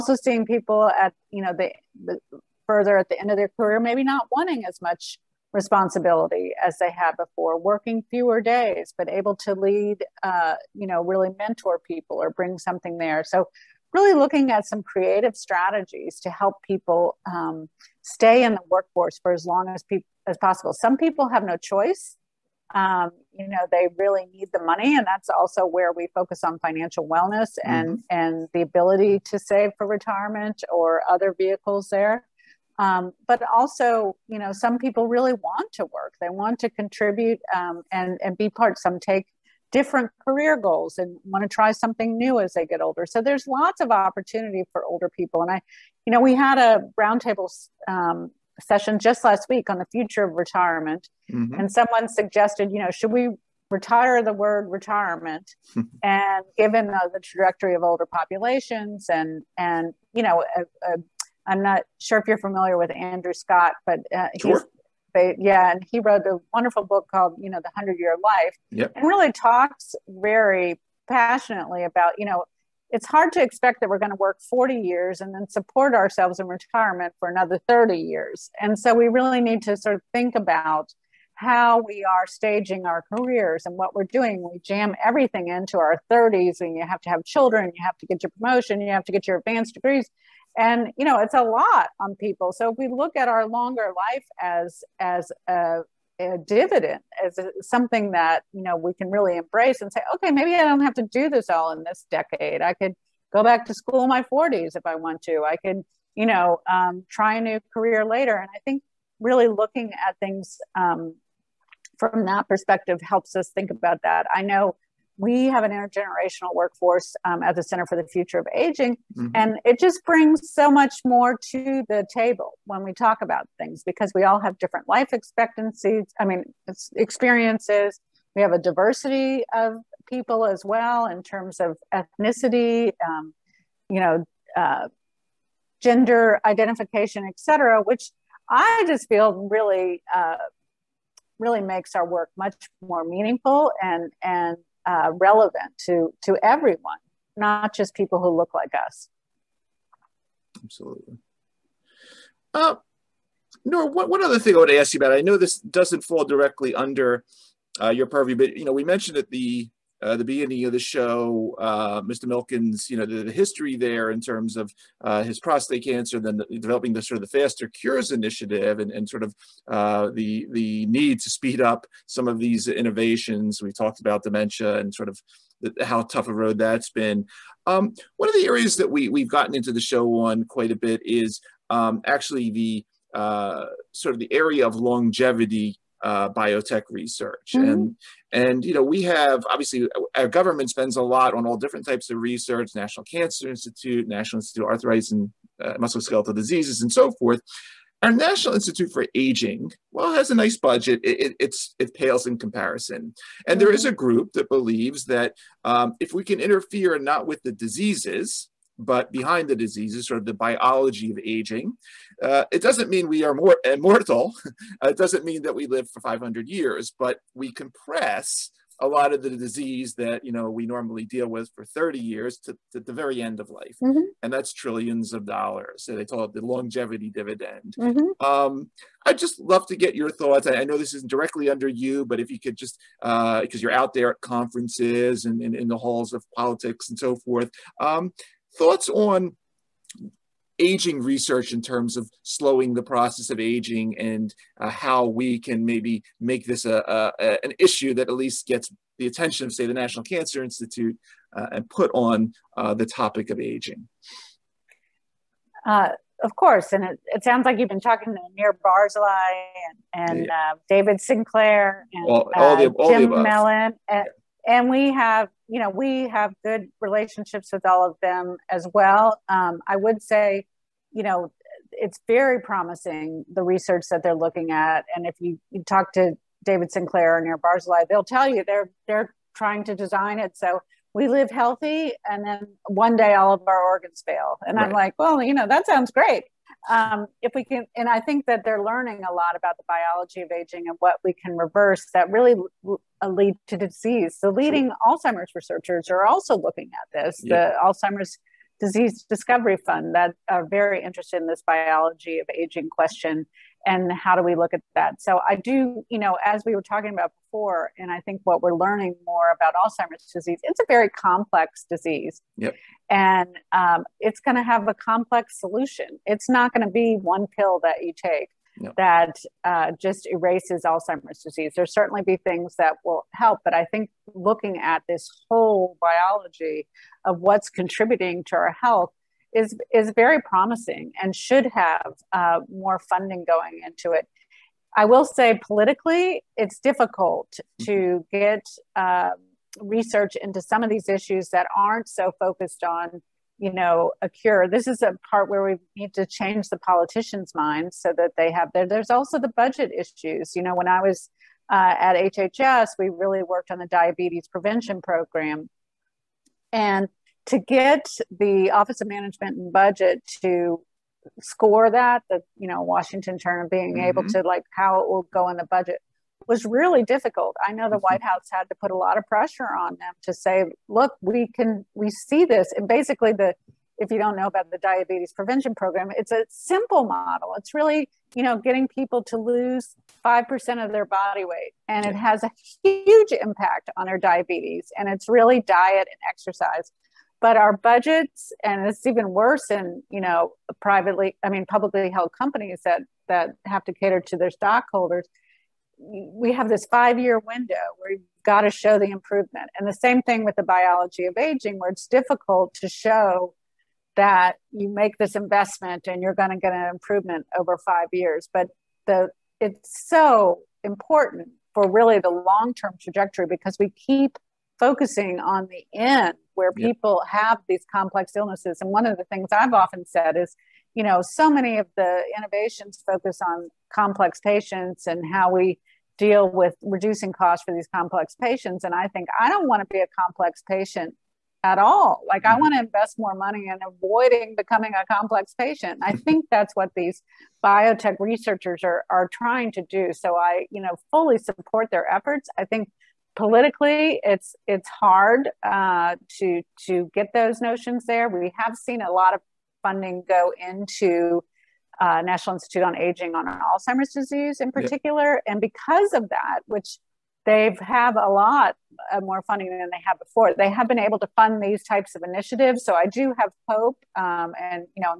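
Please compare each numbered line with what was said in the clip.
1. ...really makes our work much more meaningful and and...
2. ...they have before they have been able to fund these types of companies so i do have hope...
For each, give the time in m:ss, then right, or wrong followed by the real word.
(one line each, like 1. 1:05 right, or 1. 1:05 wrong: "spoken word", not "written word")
1. 2:21 right
2. 7:39 wrong: "initiatives", not "companies".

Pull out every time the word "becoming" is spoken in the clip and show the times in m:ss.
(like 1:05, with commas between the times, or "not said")
7:14.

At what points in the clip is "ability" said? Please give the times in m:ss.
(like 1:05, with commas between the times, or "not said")
0:28.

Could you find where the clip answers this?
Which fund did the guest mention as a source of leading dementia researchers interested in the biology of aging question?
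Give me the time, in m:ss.
4:57.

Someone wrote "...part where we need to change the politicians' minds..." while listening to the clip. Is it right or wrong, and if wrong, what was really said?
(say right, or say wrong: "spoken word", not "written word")
right.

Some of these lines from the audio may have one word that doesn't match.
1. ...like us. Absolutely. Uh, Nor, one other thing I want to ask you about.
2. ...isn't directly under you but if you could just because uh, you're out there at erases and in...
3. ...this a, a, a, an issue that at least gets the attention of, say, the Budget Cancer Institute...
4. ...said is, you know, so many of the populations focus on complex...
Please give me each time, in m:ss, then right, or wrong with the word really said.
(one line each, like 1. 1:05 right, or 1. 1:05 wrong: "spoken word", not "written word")
1. 2:28 right
2. 3:50 wrong: "conferences", not "erases"
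3. 4:06 wrong: "National", not "Budget"
4. 6:59 wrong: "innovations", not "populations".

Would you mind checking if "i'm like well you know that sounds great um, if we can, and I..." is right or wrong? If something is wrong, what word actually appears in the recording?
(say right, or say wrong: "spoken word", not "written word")
right.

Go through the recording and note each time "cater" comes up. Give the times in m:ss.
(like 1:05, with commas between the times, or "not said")
6:33.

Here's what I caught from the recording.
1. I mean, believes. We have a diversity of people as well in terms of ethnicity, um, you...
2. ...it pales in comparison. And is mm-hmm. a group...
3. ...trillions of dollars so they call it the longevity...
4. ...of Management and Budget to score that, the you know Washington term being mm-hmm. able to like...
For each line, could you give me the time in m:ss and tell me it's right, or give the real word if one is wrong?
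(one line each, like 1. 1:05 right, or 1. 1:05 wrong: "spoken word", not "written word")
1. 2:06 wrong: "experiences", not "believes"
2. 3:21 right
3. 3:44 right
4. 5:58 right.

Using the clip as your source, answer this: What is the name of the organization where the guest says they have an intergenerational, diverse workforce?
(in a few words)
Center for the Future of Aging.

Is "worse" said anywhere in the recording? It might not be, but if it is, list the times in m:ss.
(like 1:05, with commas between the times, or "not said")
6:29.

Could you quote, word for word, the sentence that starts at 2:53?
We talked about dementia and sort of the, how tough a road that's been.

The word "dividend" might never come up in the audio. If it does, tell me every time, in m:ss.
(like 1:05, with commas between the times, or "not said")
1:36, 3:47.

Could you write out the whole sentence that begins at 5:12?
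and um, it's going to have a complex solution it's not going to be one pill that you take no.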